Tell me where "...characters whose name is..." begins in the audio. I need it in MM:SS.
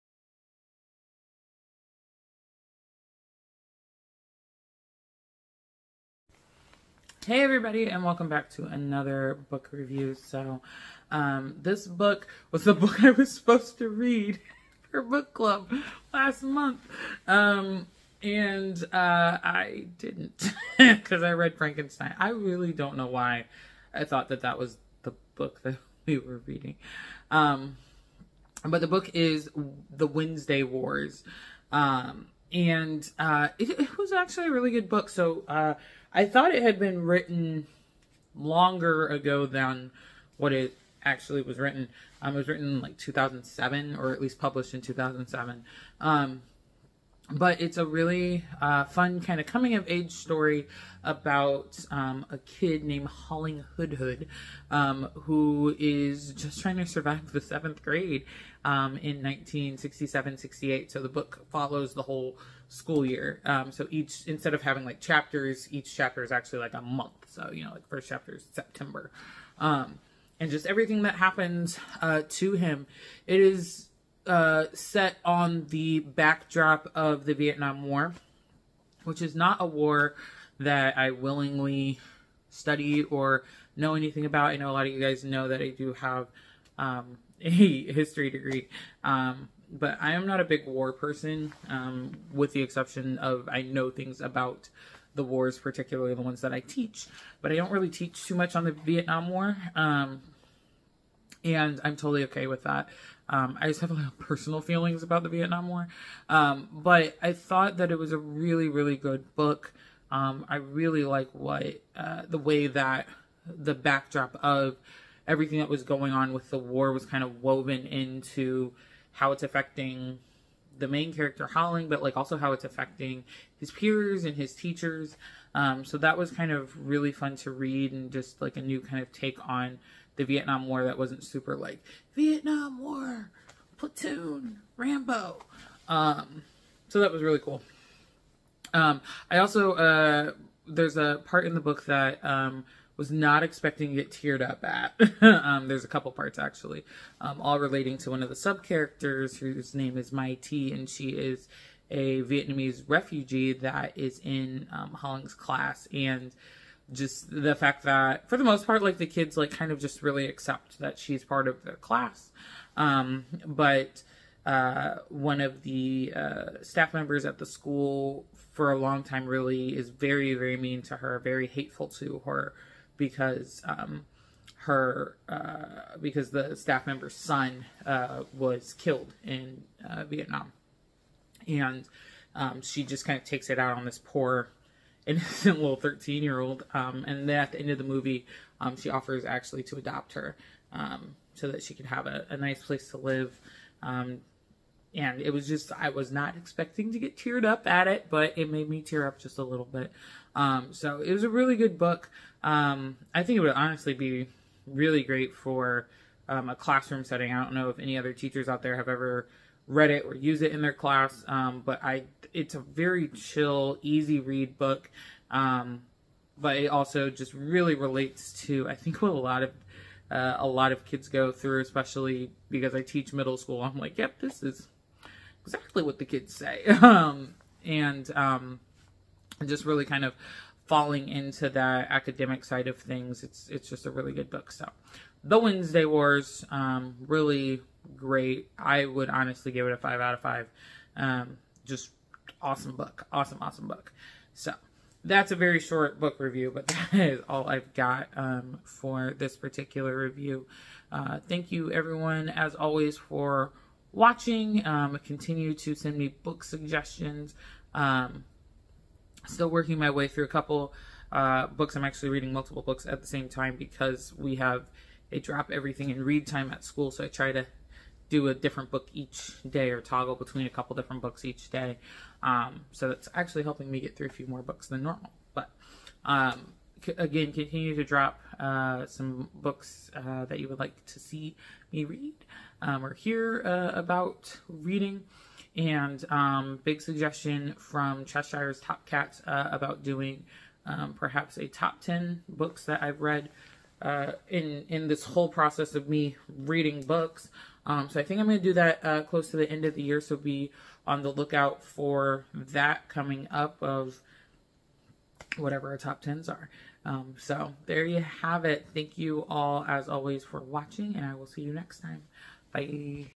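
02:28.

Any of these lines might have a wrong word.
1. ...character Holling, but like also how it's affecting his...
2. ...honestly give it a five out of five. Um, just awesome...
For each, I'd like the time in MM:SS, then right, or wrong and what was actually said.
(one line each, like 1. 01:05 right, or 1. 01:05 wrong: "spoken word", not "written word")
1. 02:01 right
2. 03:59 right.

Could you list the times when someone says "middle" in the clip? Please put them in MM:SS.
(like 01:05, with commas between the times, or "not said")
03:43.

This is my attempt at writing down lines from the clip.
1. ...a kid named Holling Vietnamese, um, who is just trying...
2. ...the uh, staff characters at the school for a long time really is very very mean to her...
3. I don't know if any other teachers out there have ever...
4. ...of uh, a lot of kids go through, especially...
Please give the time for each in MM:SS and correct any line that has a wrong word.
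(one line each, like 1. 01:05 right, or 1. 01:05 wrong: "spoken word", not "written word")
1. 00:52 wrong: "Hoodhood", not "Vietnamese"
2. 02:45 wrong: "members", not "characters"
3. 03:27 right
4. 03:39 right.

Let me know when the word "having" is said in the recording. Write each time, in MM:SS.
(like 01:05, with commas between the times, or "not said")
01:04.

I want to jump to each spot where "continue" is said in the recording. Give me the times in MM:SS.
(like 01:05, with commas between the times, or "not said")
04:15, 04:37.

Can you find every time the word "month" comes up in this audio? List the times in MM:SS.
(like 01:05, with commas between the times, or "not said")
00:16, 01:06.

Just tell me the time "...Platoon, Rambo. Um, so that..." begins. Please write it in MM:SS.
02:13.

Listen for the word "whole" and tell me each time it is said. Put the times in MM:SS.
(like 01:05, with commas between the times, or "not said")
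01:02, 04:55.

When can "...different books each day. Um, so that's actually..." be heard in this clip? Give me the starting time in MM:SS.
04:30.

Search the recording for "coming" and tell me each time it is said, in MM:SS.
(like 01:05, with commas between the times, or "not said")
00:49, 05:02.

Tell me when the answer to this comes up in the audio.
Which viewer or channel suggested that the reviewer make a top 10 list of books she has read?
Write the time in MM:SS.
04:48.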